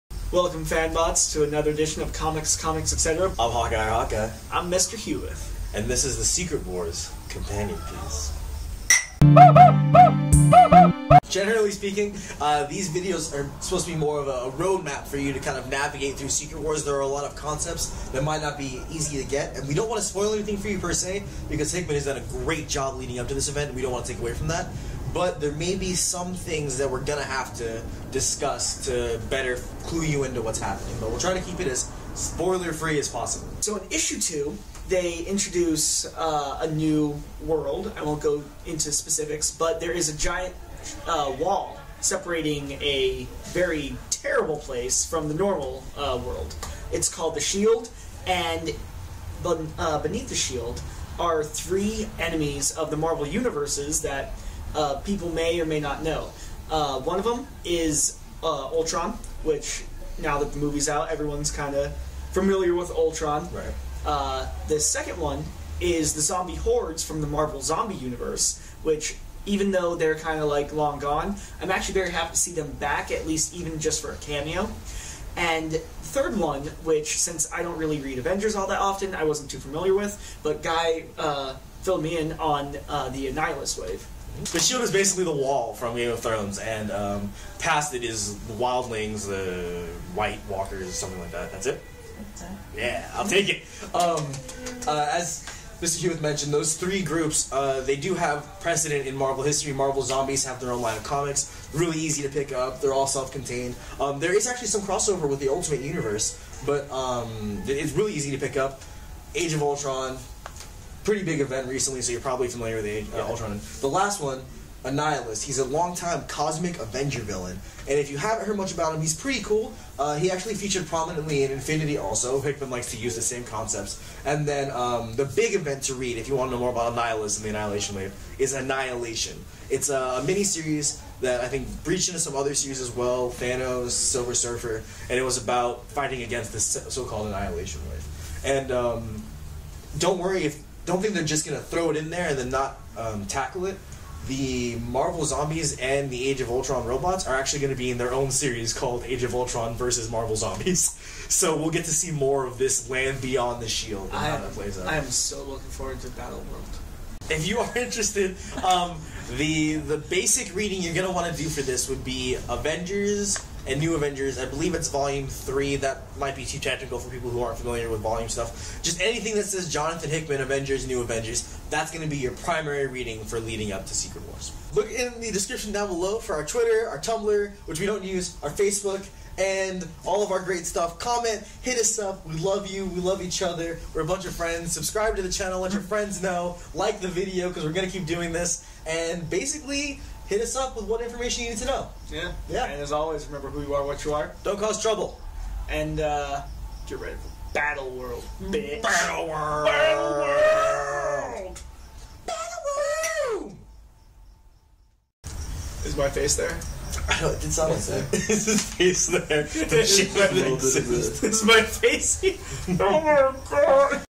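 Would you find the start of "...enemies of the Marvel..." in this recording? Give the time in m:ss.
0:52.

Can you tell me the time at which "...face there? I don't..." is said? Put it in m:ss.
3:26.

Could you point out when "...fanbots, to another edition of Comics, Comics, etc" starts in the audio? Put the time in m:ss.
0:00.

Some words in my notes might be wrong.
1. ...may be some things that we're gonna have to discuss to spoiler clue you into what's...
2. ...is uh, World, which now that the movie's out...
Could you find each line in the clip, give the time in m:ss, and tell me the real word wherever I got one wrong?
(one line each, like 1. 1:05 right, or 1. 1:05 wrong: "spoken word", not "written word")
1. 0:25 wrong: "better", not "spoiler"
2. 0:57 wrong: "Ultron", not "World".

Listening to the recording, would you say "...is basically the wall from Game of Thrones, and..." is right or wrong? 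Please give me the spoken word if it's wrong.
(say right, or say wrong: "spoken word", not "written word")
right.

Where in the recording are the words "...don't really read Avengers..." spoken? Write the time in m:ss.
1:17.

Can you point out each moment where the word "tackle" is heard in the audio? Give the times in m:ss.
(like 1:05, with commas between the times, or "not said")
2:23.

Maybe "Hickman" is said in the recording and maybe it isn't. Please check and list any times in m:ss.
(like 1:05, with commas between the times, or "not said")
0:21, 2:02, 2:50.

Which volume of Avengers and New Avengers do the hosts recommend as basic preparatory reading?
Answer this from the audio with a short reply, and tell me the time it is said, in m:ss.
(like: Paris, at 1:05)
Volume 3, at 2:44.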